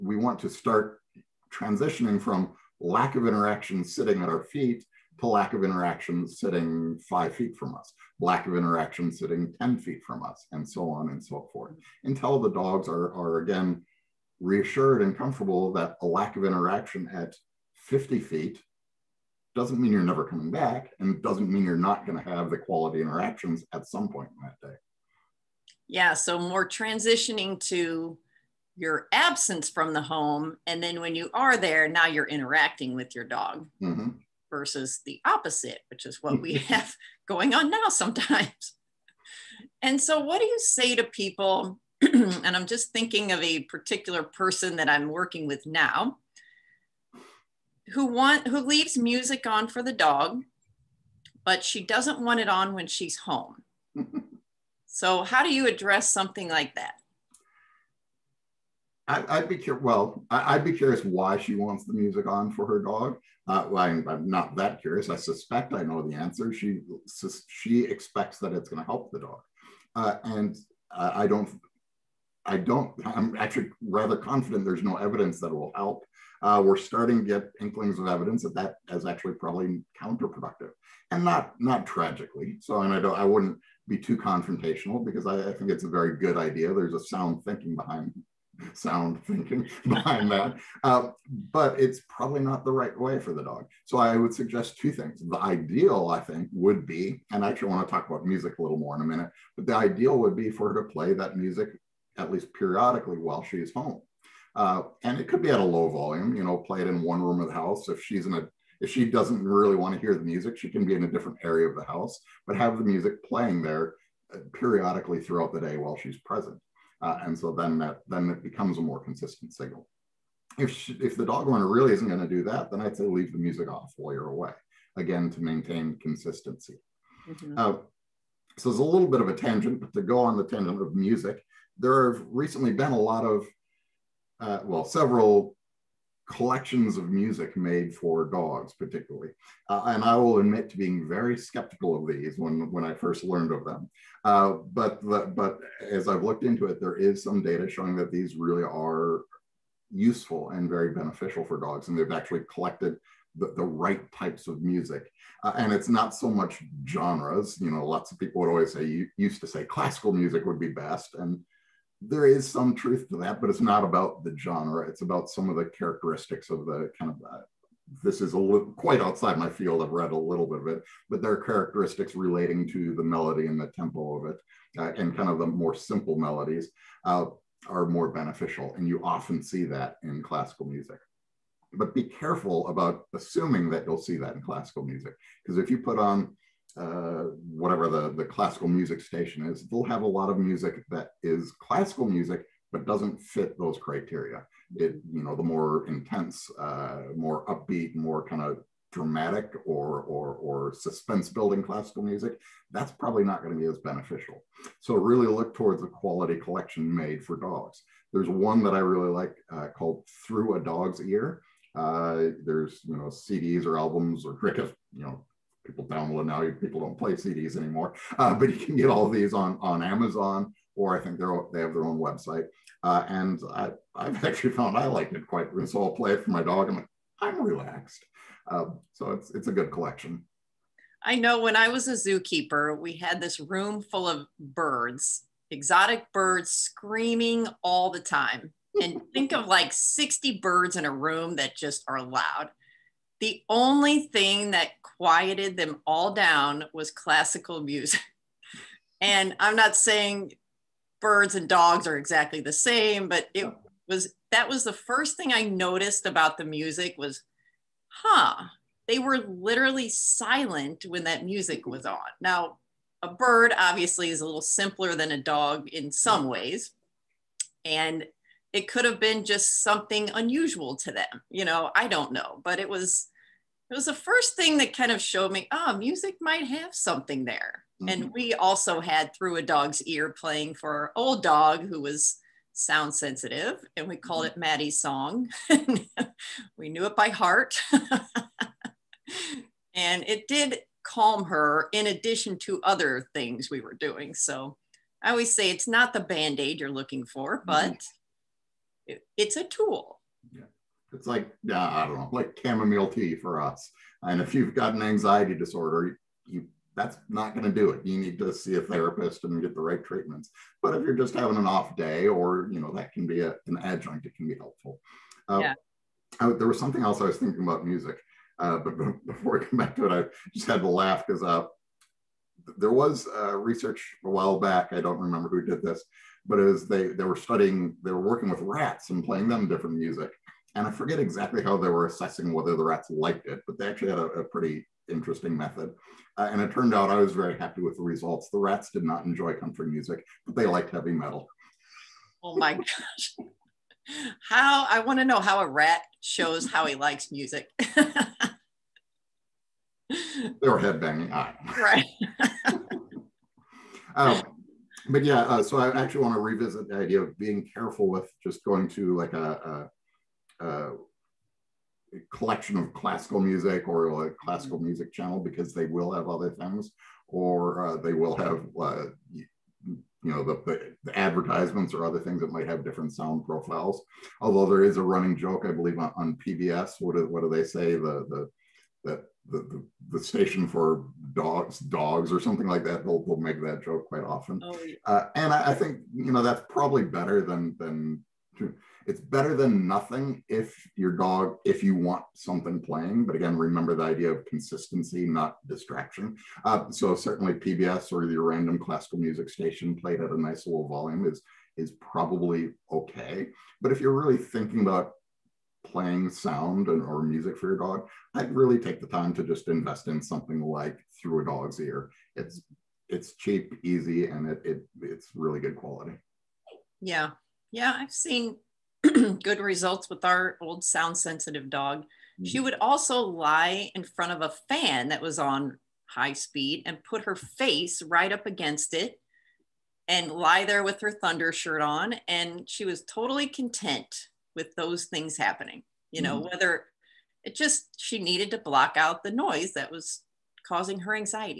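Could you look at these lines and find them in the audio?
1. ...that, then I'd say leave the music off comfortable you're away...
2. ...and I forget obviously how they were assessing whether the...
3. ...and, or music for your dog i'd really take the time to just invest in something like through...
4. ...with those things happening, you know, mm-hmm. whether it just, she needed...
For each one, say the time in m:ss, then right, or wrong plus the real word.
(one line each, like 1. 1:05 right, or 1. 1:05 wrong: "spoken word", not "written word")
1. 2:02 wrong: "while", not "comfortable"
2. 5:30 wrong: "exactly", not "obviously"
3. 6:46 right
4. 7:14 right.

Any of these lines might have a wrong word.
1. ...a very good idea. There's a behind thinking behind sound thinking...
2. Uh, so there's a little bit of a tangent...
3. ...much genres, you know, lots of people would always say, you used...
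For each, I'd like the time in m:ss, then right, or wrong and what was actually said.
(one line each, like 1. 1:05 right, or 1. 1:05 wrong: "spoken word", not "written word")
1. 1:25 wrong: "sound", not "behind"
2. 2:07 right
3. 2:36 right.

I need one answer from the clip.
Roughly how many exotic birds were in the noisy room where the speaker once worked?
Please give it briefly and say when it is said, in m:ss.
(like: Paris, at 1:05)
60, at 3:59.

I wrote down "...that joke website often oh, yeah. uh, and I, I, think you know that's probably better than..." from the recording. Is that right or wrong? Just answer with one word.
wrong.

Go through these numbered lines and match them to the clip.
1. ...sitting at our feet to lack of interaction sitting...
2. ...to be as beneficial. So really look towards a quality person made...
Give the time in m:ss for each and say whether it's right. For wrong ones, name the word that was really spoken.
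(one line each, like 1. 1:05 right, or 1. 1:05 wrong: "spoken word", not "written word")
1. 0:03 right
2. 3:23 wrong: "collection", not "person".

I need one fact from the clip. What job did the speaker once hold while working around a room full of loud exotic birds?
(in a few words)
zookeeper.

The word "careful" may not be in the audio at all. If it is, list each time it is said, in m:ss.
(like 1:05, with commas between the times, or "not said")
3:02, 5:57.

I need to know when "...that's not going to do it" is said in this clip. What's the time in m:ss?
5:06.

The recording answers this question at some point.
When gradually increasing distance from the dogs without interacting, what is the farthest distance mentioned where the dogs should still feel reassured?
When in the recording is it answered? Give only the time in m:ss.
0:17.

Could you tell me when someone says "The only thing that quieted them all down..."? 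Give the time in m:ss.
4:03.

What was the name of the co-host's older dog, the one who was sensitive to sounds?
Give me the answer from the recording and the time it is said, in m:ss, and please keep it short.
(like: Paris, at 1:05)
Maddie, at 4:44.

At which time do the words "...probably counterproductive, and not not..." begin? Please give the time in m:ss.
1:19.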